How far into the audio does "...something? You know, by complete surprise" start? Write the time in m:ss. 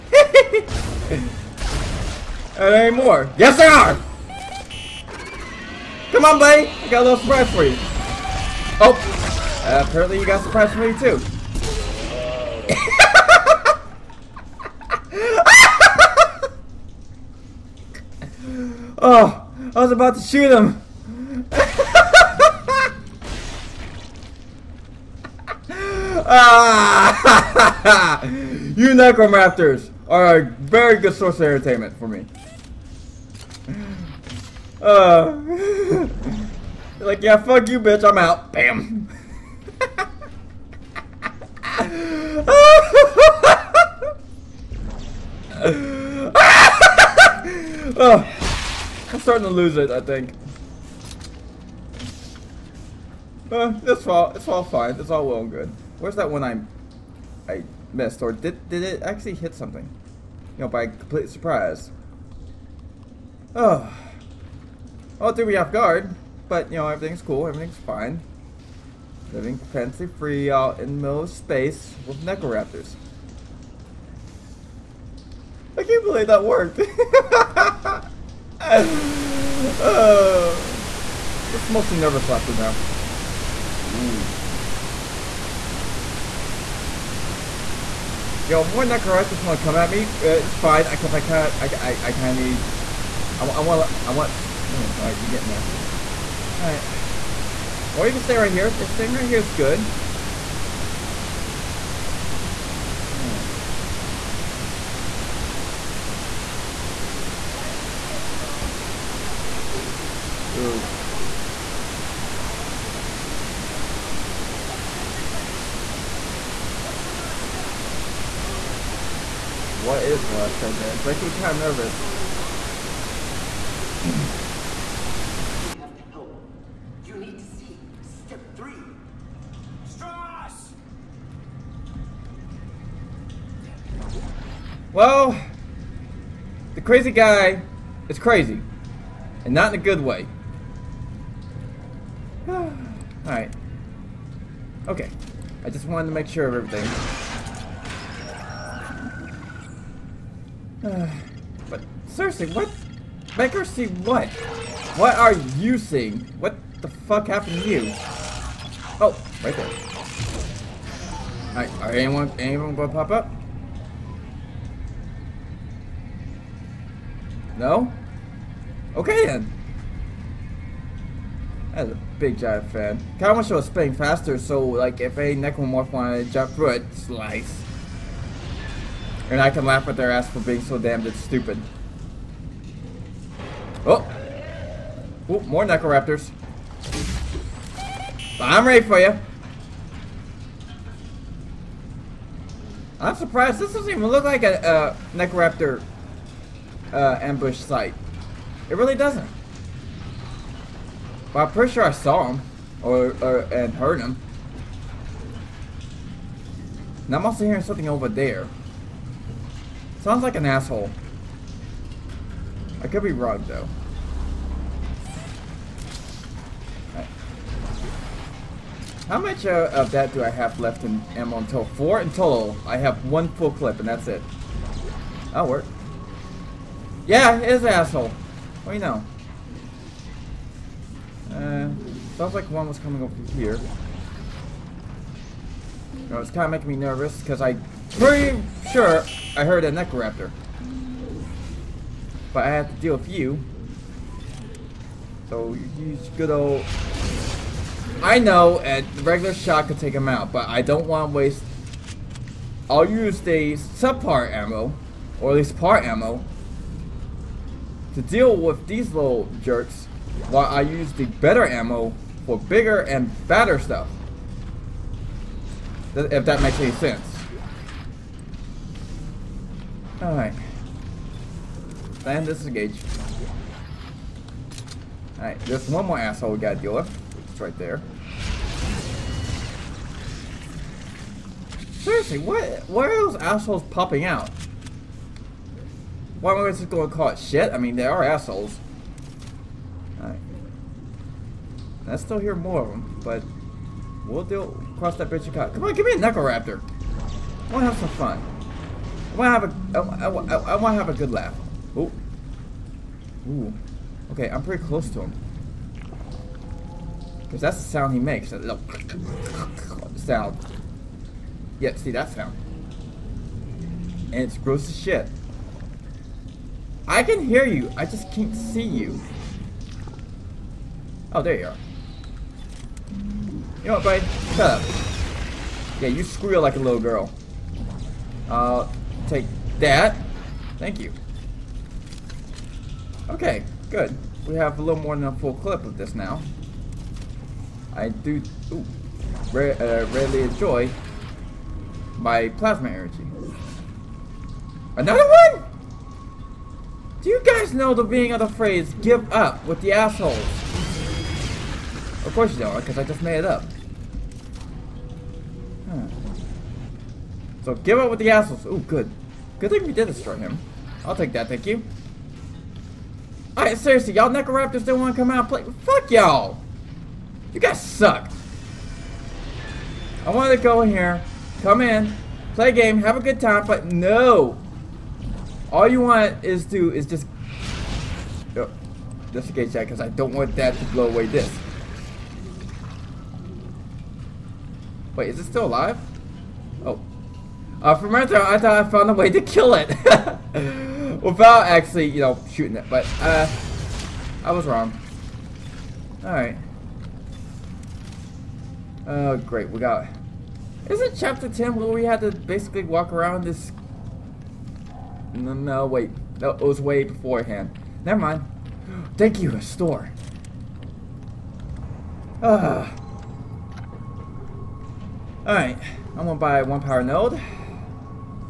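0:59.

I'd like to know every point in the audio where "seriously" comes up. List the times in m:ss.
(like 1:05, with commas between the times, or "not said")
2:32, 4:41, 6:03.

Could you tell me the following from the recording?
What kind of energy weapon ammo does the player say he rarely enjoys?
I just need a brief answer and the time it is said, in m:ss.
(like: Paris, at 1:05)
plasma energy, at 5:42.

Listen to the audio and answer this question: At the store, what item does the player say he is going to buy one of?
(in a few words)
power node.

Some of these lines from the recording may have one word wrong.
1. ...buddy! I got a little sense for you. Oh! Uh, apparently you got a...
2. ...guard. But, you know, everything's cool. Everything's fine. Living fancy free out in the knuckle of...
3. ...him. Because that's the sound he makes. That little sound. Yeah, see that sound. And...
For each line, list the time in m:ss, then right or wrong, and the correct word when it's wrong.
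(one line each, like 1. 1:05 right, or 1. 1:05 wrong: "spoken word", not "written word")
1. 0:06 wrong: "surprise", not "sense"
2. 1:05 wrong: "middle", not "knuckle"
3. 5:05 right.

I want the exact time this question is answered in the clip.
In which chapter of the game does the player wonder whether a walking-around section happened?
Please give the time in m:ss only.
6:40.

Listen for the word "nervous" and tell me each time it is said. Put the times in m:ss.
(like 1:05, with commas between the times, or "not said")
1:21, 2:01, 3:56.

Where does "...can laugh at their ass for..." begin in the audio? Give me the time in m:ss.
2:59.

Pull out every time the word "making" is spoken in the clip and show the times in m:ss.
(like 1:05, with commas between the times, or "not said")
2:01, 3:56.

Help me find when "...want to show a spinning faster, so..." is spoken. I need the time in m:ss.
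2:53.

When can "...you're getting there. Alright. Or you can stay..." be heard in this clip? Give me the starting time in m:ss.
1:35.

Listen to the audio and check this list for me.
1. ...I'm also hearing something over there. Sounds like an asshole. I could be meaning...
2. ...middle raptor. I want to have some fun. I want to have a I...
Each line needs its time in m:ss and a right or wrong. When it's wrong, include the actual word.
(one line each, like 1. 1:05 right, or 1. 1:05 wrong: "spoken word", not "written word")
1. 3:27 wrong: "wrong", not "meaning"
2. 4:55 wrong: "knuckle", not "middle".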